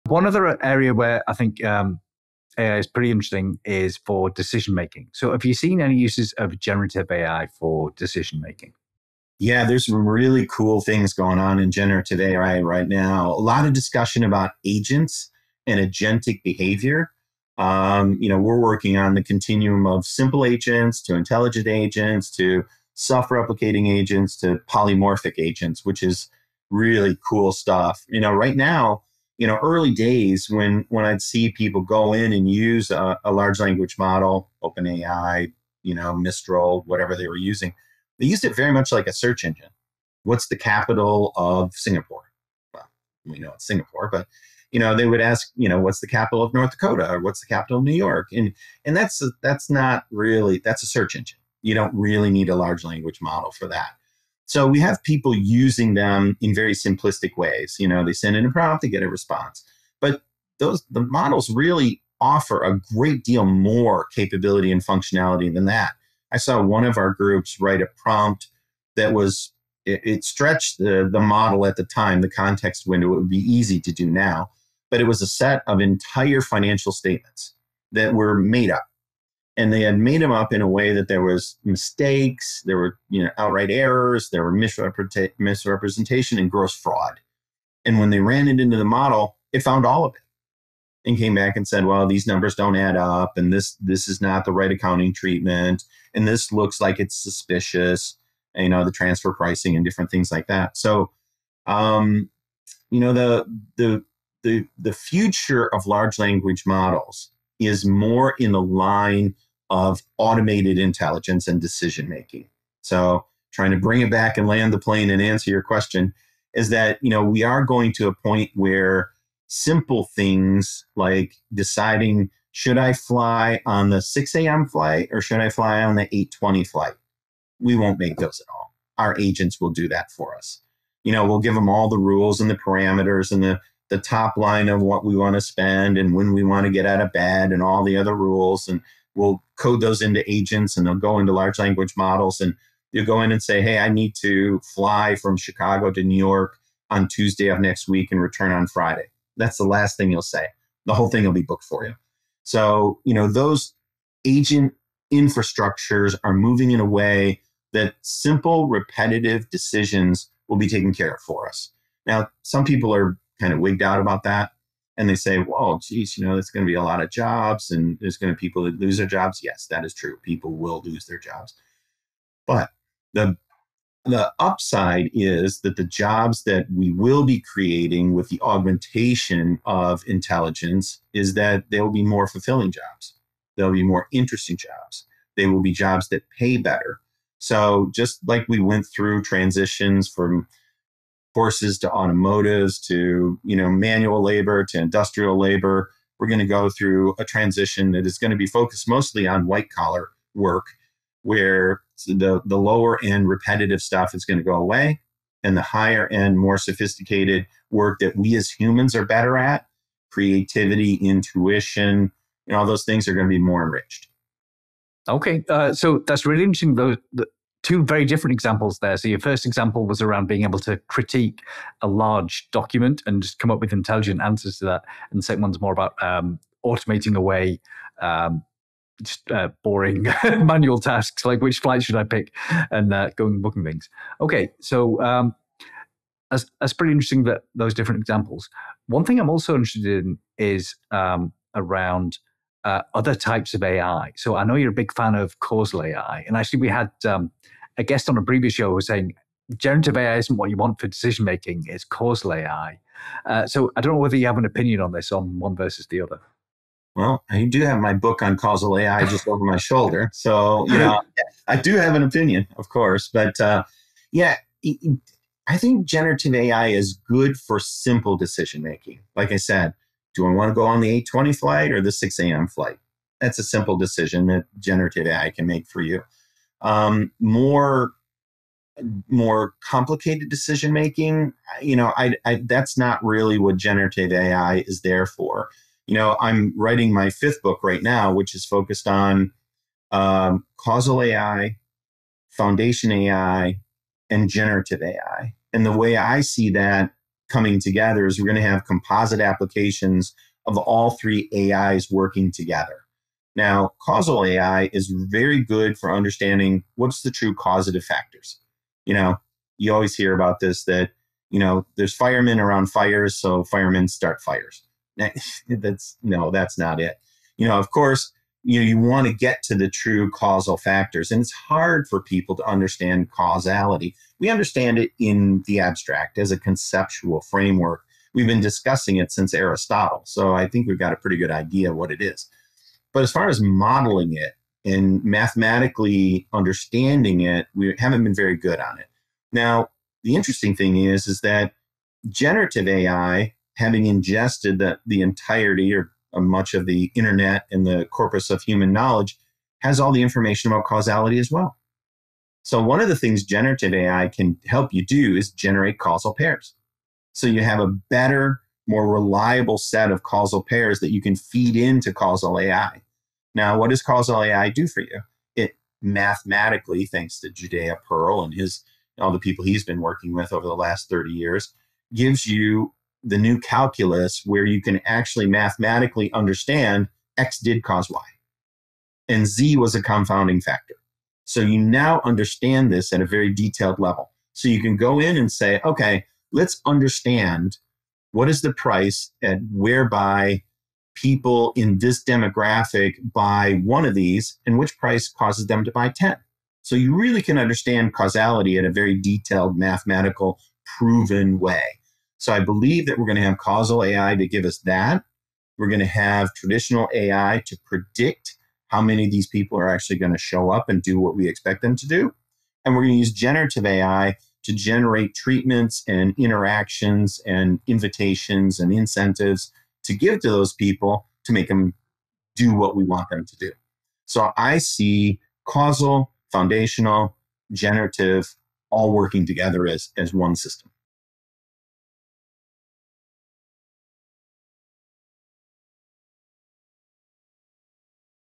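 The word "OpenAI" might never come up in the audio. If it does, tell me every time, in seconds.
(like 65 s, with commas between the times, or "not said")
34 s.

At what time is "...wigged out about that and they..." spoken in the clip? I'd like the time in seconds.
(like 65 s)
163 s.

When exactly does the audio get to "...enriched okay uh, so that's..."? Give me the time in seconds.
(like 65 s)
213 s.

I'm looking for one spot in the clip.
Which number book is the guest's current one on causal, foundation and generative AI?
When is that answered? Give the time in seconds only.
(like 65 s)
287 s.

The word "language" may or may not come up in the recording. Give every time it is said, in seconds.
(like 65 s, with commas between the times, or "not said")
33 s, 52 s, 106 s, 141 s.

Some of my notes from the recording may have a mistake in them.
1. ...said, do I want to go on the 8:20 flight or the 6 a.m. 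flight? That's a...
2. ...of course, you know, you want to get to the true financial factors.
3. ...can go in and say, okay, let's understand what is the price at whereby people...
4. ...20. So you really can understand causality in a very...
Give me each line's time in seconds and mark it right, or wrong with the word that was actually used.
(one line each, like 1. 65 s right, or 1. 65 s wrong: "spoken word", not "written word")
1. 269 s right
2. 317 s wrong: "causal", not "financial"
3. 384 s right
4. 395 s wrong: "10", not "20".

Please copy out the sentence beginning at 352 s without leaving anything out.
So, one of the things generative AI can help you do is generate causal pairs.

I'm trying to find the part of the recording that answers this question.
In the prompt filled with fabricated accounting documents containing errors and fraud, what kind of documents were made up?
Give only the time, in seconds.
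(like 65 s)
76 s.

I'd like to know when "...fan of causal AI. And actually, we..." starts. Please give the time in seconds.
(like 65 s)
244 s.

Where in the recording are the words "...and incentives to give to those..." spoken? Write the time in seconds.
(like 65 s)
418 s.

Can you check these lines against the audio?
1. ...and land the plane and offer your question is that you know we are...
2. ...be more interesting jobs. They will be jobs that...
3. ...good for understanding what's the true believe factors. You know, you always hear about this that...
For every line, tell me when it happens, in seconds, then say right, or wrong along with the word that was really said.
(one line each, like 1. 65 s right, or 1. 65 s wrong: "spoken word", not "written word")
1. 114 s wrong: "answer", not "offer"
2. 183 s right
3. 305 s wrong: "causative", not "believe".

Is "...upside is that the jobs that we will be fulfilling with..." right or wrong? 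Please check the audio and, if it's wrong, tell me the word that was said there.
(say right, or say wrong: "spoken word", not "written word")
wrong: "creating", not "fulfilling".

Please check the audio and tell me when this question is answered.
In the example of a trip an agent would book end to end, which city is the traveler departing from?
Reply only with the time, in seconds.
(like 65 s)
145 s.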